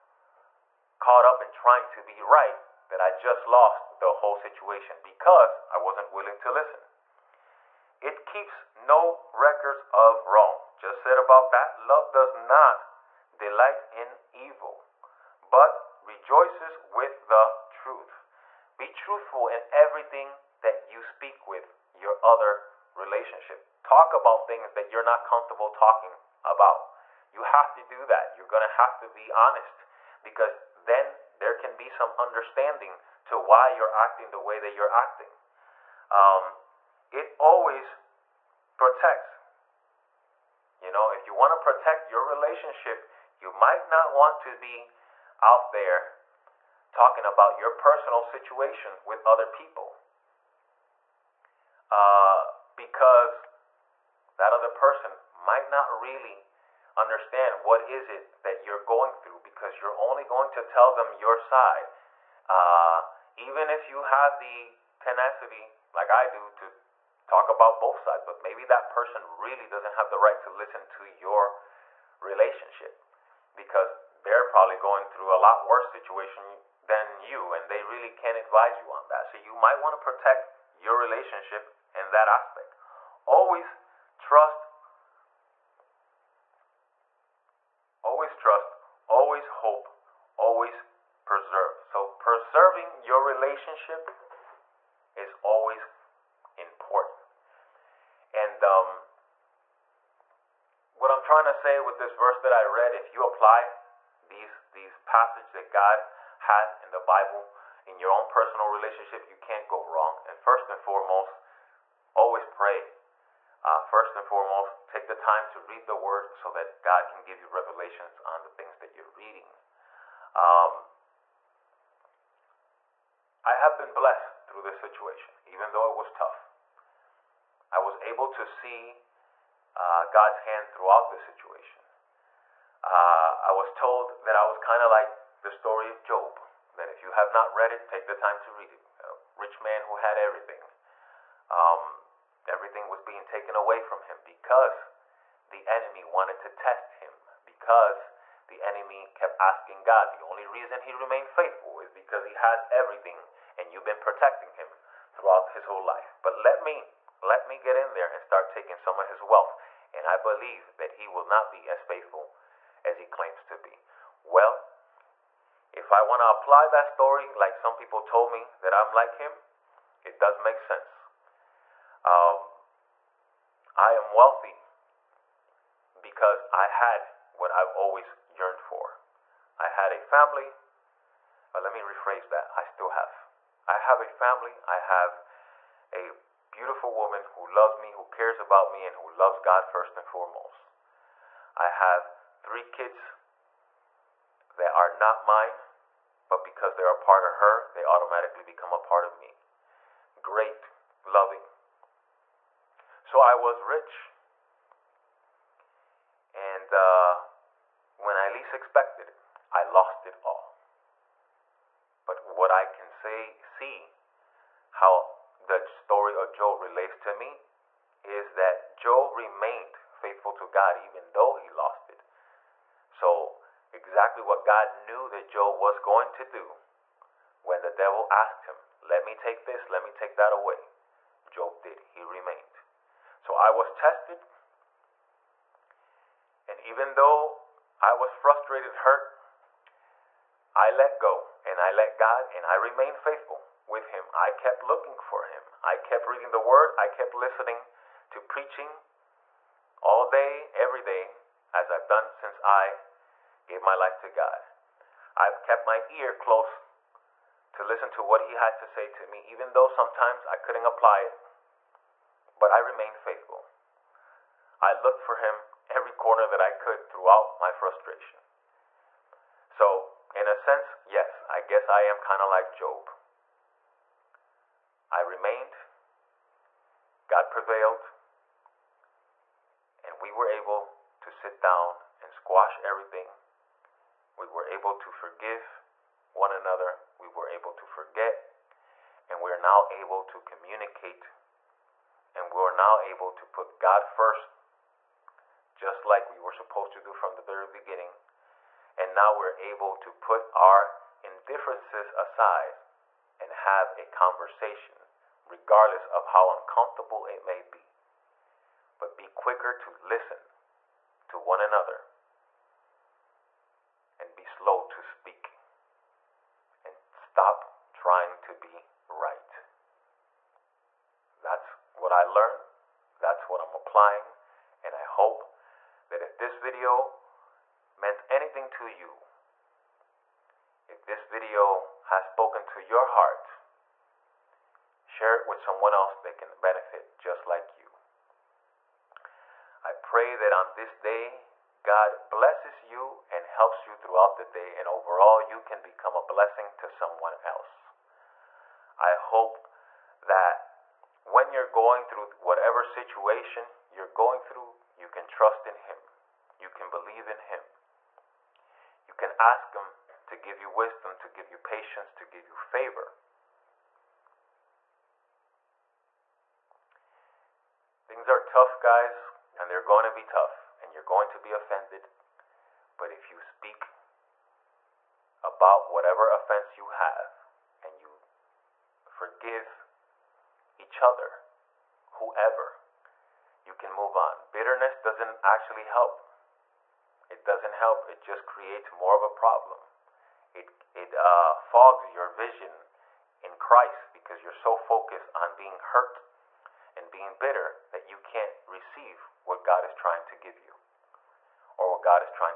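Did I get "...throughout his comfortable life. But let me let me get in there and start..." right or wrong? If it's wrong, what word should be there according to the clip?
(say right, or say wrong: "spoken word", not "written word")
wrong: "whole", not "comfortable".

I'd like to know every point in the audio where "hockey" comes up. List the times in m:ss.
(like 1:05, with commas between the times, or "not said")
not said.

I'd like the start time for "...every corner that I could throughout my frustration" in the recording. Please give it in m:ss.
4:25.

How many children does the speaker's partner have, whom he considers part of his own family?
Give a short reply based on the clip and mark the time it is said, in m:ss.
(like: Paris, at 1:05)
3, at 3:12.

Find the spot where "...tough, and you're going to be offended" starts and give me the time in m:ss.
6:10.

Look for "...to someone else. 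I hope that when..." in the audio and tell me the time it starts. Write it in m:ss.
5:46.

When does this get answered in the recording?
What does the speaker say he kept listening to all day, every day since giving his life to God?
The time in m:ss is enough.
4:08.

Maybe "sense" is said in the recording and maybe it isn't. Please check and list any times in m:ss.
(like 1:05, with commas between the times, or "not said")
2:50, 4:30.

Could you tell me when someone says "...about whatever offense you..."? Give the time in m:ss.
6:15.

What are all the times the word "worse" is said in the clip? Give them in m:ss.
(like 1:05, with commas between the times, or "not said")
1:15.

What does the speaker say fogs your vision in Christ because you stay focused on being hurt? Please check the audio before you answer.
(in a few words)
Bitterness.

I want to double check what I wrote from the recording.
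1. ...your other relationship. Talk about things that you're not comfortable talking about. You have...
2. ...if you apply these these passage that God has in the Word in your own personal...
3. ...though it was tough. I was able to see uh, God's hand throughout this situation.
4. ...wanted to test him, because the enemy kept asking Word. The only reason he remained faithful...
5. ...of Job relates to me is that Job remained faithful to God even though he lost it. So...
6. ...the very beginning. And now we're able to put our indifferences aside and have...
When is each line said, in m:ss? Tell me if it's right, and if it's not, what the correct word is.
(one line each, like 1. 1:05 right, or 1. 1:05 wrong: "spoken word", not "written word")
1. 0:21 right
2. 1:42 wrong: "Bible", not "Word"
3. 2:05 right
4. 2:26 wrong: "God", not "Word"
5. 3:36 right
6. 4:57 right.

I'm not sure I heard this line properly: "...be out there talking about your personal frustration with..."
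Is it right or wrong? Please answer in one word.
wrong.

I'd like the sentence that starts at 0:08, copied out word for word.
It keeps no records of wrong.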